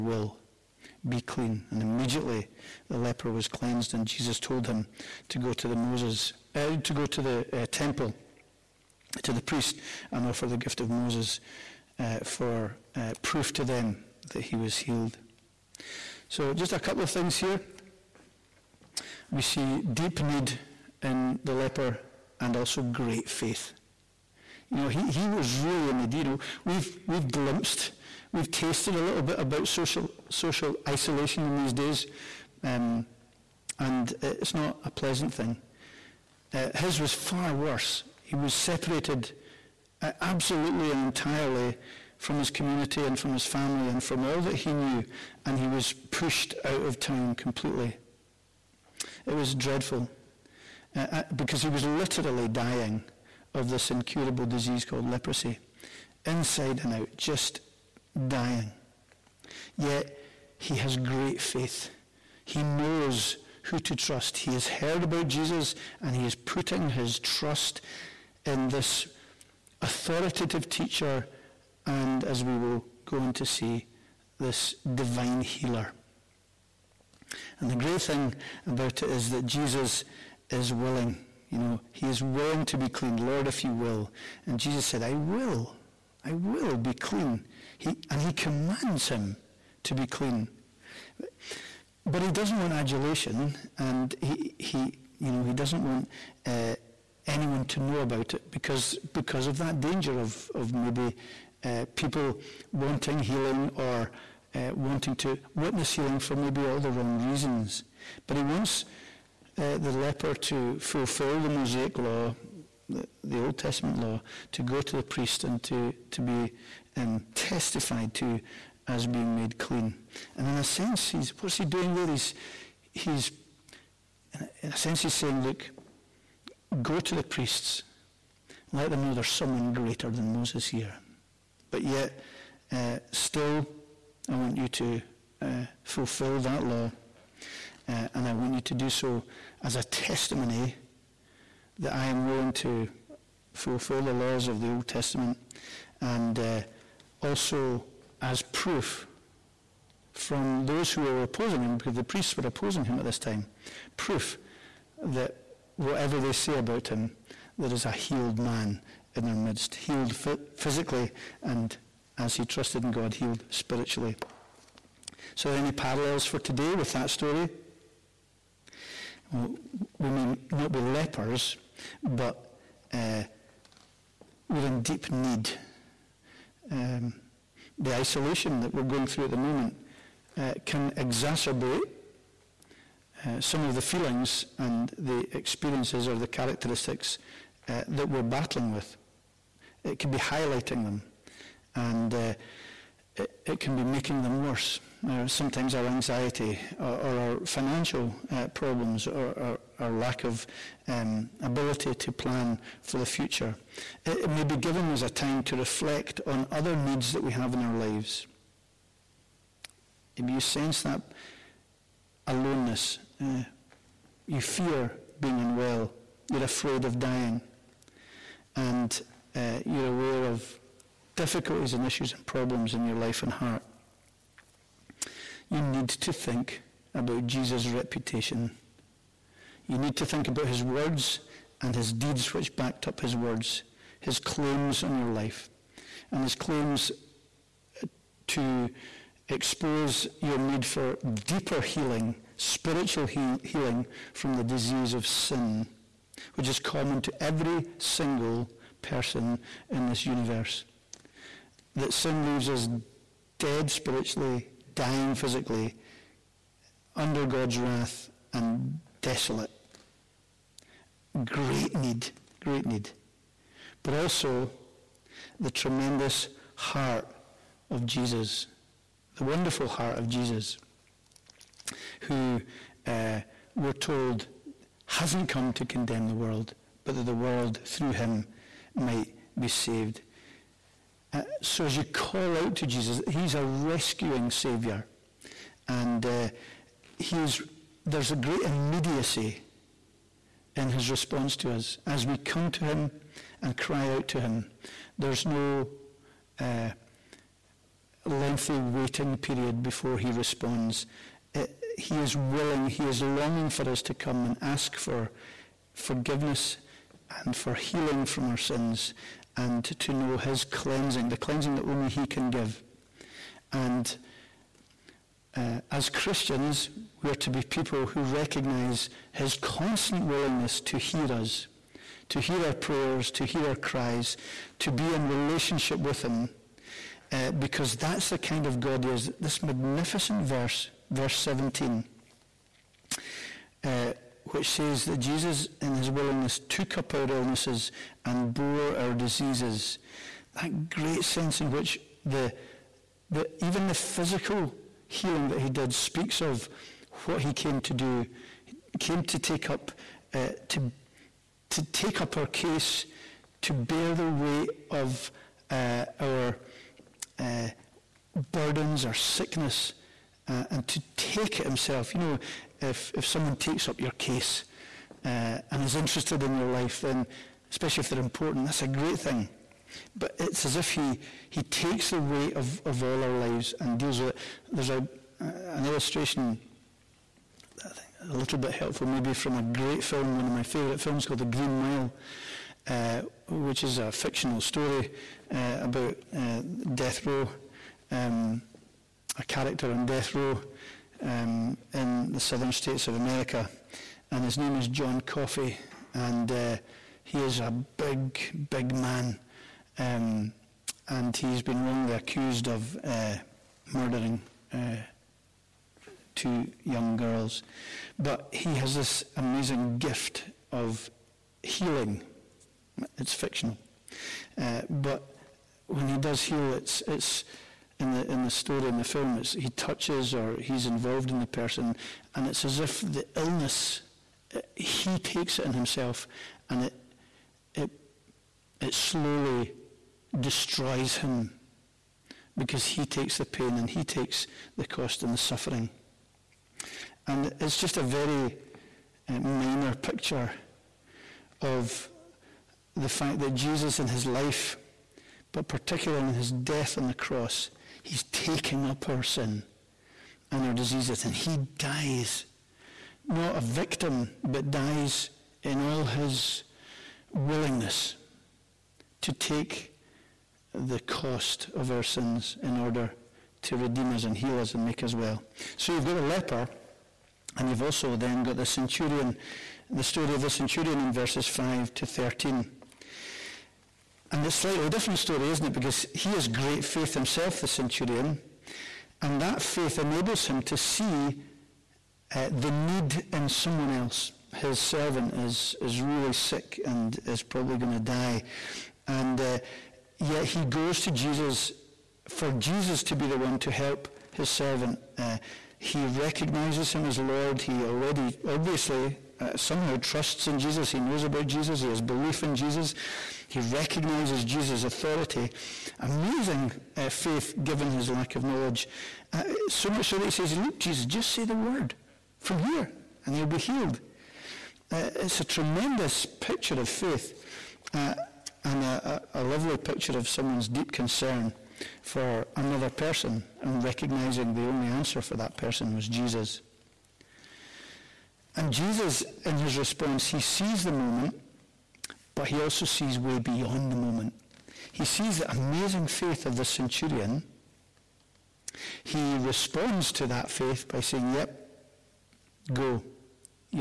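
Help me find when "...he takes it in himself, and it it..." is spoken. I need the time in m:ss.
7:04.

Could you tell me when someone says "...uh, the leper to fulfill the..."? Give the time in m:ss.
1:49.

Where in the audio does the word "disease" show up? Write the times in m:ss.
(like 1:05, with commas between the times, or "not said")
0:54, 4:04, 5:38, 7:30.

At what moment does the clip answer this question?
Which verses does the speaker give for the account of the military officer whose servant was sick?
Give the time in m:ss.
7:50.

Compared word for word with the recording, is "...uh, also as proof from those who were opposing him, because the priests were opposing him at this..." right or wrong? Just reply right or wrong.
right.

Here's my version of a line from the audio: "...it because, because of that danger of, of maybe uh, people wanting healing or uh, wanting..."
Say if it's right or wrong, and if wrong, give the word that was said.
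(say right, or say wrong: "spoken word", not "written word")
right.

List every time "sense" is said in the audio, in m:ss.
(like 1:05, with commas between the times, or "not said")
2:00, 2:04, 3:30, 5:41.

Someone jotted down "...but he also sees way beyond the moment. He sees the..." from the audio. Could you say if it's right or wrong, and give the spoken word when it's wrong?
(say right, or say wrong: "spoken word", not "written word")
right.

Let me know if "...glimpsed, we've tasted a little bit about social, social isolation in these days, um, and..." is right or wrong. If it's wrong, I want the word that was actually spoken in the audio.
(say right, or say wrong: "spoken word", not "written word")
right.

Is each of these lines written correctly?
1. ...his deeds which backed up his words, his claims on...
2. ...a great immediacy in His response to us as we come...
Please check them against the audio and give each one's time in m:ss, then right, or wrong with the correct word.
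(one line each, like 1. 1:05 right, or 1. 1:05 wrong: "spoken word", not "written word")
1. 3:51 right
2. 4:48 right.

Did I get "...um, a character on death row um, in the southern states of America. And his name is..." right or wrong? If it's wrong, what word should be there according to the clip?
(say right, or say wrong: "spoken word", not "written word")
right.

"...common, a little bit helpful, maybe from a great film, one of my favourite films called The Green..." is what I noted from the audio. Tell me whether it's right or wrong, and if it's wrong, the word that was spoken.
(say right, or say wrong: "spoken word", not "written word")
wrong: "illustration", not "common".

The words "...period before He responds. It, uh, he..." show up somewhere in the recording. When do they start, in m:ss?
4:59.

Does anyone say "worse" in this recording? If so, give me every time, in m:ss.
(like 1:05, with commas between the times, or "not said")
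0:37, 3:14.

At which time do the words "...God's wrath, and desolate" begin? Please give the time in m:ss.
4:17.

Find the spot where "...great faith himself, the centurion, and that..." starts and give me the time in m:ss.
7:56.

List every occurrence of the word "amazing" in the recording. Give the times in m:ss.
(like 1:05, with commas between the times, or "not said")
6:49, 8:25, 8:55.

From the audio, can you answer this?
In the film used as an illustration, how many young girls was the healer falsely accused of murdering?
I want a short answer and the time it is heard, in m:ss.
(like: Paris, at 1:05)
2, at 6:46.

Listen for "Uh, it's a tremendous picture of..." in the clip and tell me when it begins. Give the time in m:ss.
8:34.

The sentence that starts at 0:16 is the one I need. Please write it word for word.
So, just a couple of things here we see deep need in the leper and also great faith.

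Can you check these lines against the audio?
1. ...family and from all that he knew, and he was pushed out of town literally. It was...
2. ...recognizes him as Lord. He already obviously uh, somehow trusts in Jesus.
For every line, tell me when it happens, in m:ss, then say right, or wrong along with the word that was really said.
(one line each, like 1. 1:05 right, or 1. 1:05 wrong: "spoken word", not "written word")
1. 0:43 wrong: "completely", not "literally"
2. 8:15 right.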